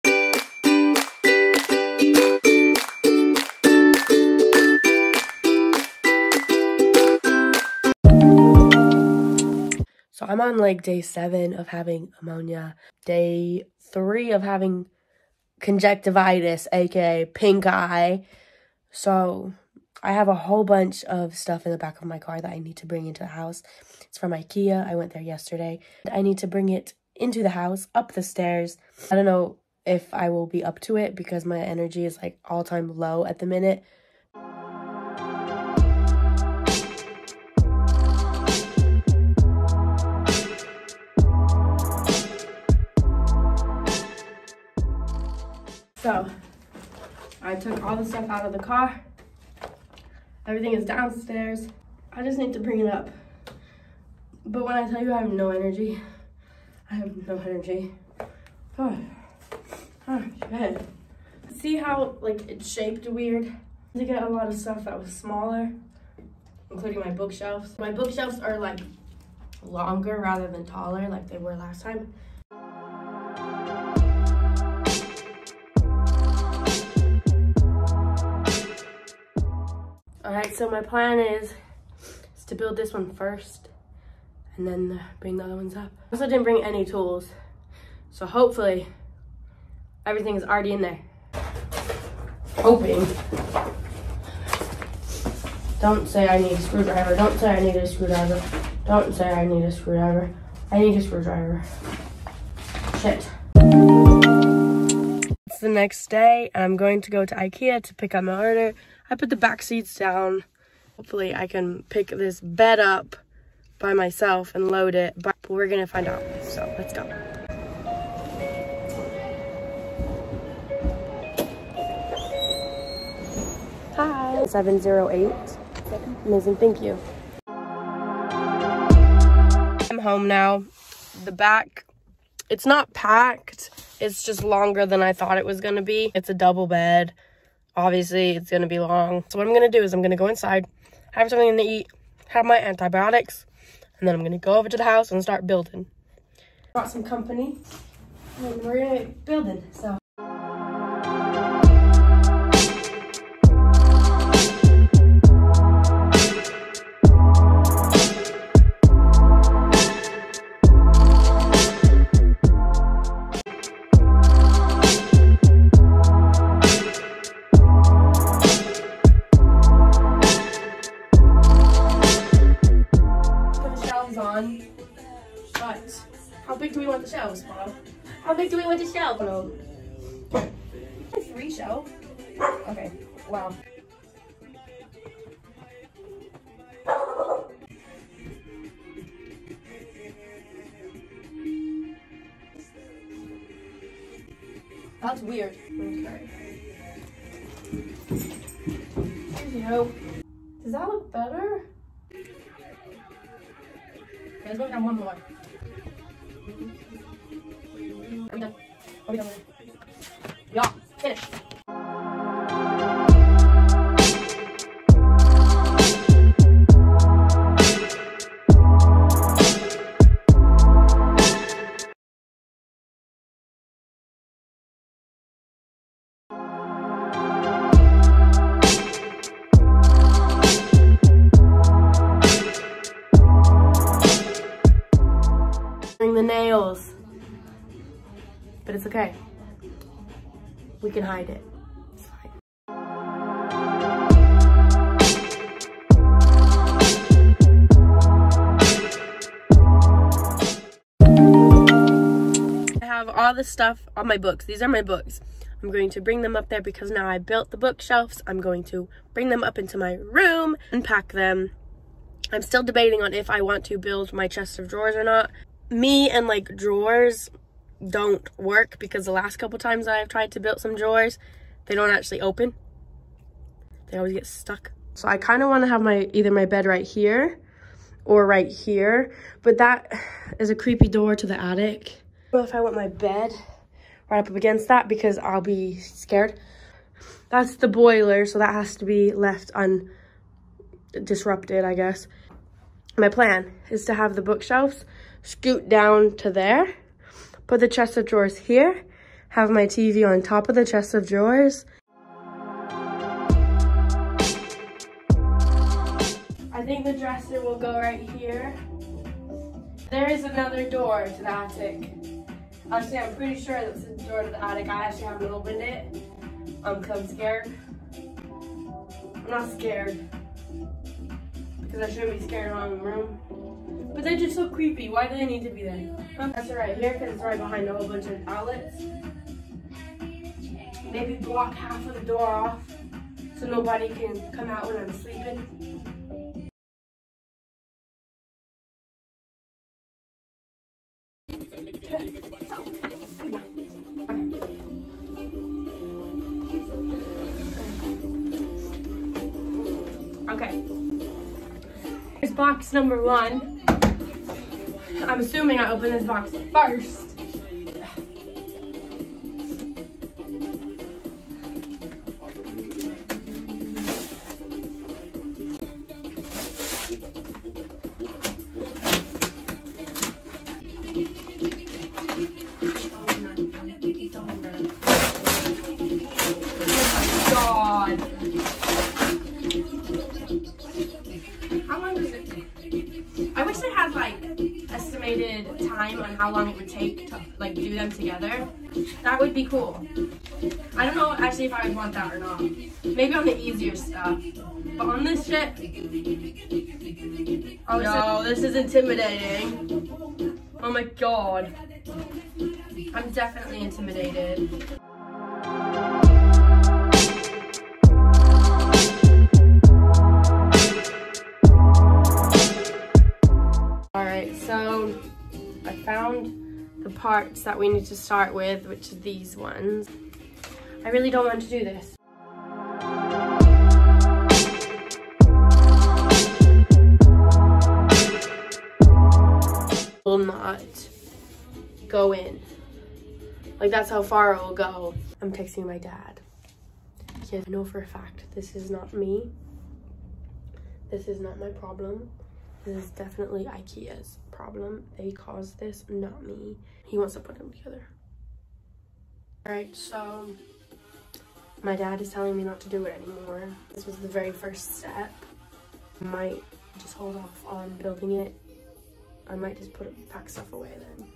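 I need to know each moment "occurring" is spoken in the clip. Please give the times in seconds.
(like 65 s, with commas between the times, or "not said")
not said.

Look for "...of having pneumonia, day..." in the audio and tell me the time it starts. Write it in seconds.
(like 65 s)
11 s.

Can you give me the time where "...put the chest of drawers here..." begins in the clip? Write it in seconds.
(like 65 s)
297 s.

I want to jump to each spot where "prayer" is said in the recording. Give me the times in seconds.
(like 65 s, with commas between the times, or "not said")
not said.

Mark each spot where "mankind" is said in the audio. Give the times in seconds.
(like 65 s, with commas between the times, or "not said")
not said.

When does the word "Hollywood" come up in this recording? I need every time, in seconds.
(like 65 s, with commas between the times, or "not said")
not said.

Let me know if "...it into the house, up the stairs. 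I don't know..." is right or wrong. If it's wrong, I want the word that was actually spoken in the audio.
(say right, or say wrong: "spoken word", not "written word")
right.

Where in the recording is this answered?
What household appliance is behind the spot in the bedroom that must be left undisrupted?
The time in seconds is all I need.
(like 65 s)
287 s.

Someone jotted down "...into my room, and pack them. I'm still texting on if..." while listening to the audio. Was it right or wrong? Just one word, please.
wrong.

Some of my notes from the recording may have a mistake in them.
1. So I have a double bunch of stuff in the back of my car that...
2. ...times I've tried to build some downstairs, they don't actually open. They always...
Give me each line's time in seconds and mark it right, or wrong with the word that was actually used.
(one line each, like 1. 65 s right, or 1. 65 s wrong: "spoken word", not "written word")
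1. 18 s wrong: "whole", not "double"
2. 269 s wrong: "drawers", not "downstairs".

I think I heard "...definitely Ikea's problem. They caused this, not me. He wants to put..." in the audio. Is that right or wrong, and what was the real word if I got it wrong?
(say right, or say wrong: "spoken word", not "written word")
right.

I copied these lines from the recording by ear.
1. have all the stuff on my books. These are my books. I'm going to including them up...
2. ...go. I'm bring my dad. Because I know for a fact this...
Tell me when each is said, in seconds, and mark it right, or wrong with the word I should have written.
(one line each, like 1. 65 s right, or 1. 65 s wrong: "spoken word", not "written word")
1. 252 s wrong: "bring", not "including"
2. 434 s wrong: "texting", not "bring".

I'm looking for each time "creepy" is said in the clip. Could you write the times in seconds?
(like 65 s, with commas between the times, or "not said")
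280 s, 324 s.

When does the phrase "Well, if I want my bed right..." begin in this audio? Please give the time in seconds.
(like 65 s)
282 s.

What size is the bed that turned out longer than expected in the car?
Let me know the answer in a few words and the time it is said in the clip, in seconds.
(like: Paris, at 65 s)
Double, at 136 s.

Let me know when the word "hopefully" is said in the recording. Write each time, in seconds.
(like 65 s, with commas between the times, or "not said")
88 s, 110 s.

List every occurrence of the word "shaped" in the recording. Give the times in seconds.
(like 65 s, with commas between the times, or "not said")
62 s.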